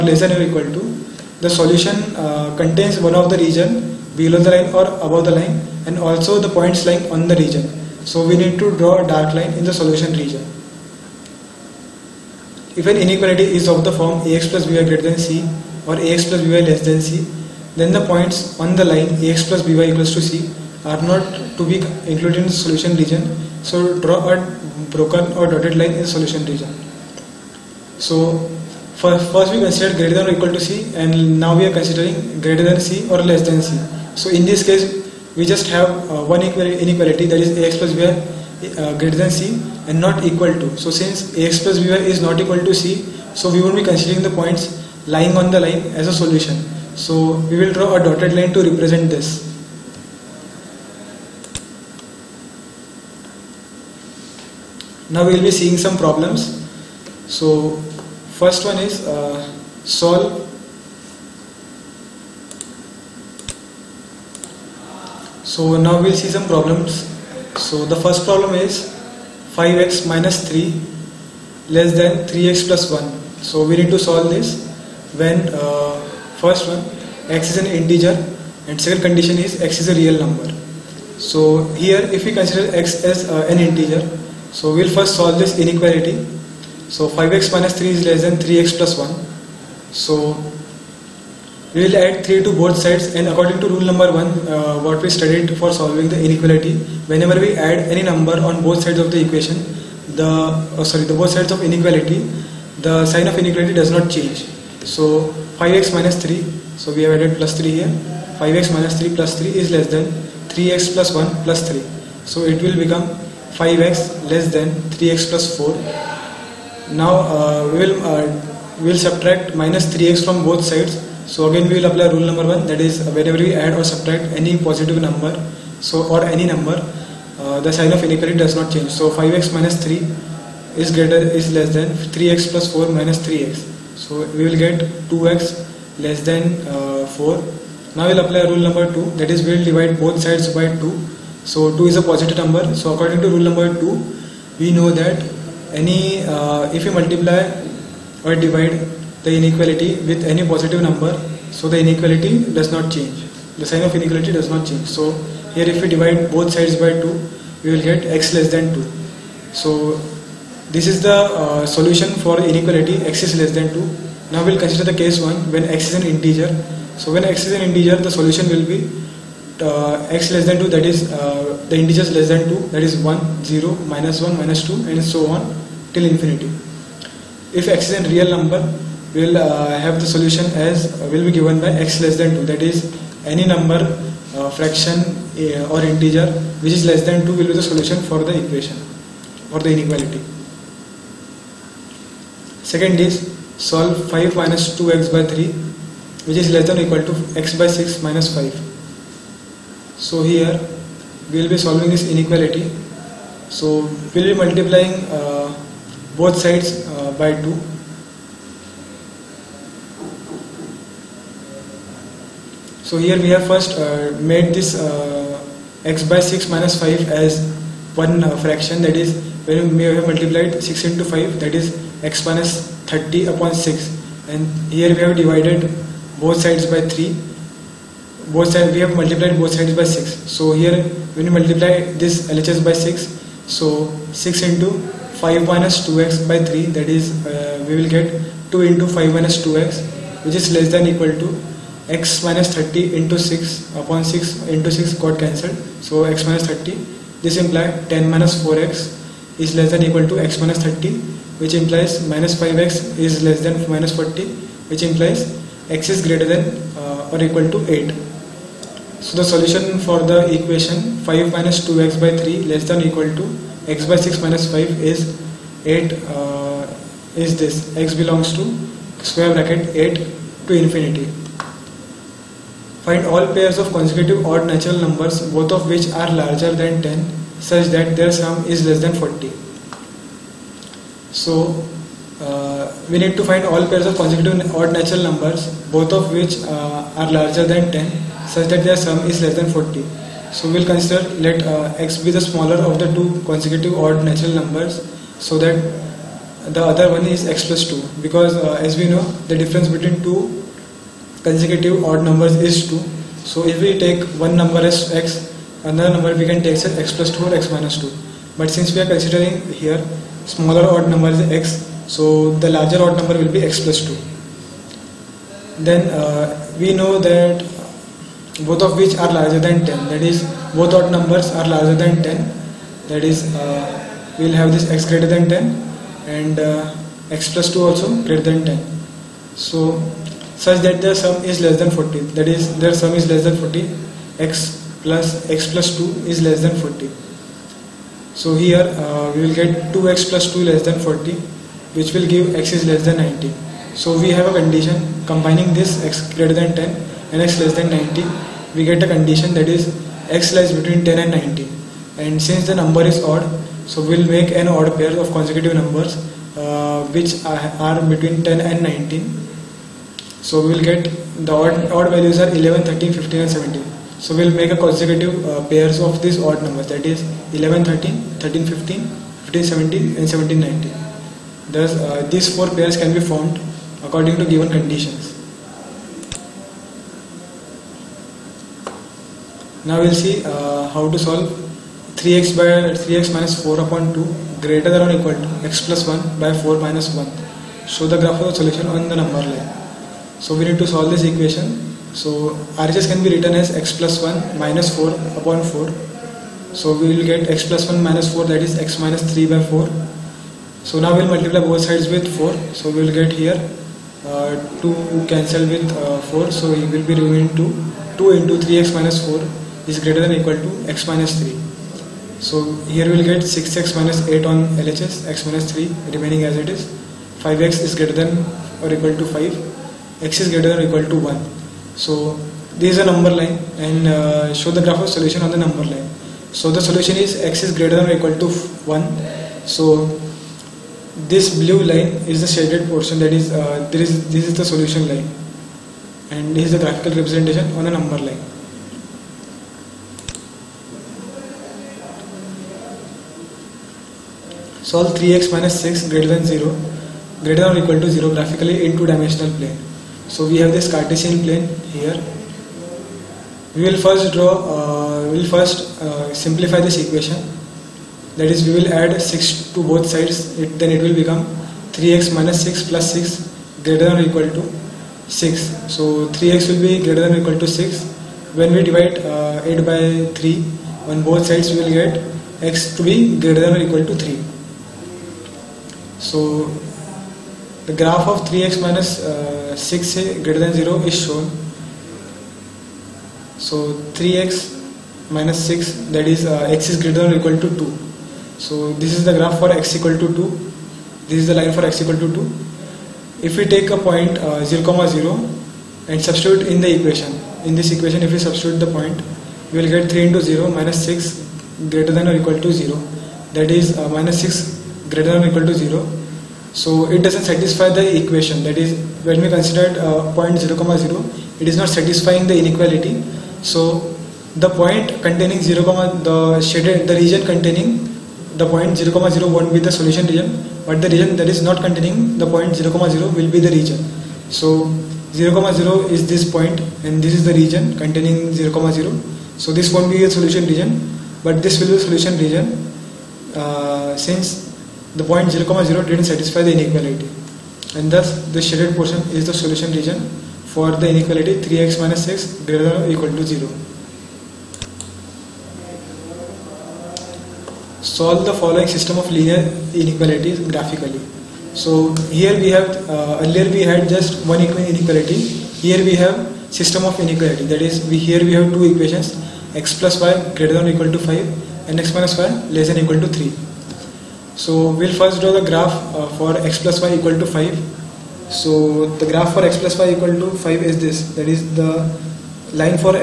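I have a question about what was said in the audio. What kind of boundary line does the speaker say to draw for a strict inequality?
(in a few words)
broken or dotted line.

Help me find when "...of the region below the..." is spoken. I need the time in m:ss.
0:03.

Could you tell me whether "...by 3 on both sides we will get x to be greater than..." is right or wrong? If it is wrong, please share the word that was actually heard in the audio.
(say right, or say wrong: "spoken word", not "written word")
right.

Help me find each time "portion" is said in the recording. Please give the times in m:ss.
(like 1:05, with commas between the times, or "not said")
7:12, 8:58.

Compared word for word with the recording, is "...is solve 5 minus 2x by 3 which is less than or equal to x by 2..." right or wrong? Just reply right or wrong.
wrong.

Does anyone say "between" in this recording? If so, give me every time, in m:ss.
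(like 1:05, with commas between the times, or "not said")
4:59, 5:50, 5:57.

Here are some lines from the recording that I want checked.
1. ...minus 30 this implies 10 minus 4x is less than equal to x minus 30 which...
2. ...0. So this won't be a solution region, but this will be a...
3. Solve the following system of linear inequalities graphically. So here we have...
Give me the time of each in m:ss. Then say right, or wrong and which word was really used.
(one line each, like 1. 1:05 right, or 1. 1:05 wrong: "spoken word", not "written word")
1. 4:06 right
2. 8:48 right
3. 9:07 right.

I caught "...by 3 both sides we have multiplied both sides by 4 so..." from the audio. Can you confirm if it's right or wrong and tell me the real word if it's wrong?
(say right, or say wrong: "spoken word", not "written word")
wrong: "6", not "4".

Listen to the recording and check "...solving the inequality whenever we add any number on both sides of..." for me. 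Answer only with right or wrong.
right.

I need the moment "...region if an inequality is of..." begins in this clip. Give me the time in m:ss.
0:10.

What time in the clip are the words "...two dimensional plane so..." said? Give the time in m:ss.
7:28.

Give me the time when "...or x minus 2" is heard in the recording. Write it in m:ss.
5:07.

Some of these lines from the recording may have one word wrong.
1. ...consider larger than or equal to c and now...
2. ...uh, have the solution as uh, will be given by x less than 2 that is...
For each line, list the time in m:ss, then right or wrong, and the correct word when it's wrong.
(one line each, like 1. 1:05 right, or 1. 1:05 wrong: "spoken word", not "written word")
1. 0:29 wrong: "greater", not "larger"
2. 2:59 right.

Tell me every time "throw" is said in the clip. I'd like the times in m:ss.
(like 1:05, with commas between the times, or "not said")
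not said.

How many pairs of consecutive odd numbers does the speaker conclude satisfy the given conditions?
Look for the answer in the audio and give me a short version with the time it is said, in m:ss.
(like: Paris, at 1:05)
4, at 6:12.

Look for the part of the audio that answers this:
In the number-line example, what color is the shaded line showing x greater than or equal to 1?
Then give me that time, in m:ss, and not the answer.
7:11.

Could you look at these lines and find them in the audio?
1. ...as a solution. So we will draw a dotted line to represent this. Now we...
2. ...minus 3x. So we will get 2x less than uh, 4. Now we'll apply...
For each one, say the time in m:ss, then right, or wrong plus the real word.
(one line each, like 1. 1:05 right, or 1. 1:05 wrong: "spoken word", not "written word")
1. 0:45 right
2. 2:12 right.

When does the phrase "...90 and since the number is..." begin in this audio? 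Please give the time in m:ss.
5:51.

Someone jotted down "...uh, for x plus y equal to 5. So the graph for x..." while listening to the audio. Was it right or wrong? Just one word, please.
right.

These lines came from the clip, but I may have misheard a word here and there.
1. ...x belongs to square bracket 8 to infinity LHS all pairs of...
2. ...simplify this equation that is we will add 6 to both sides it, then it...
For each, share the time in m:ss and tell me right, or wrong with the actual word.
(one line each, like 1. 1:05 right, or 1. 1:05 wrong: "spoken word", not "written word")
1. 4:27 wrong: "Find", not "LHS"
2. 7:36 right.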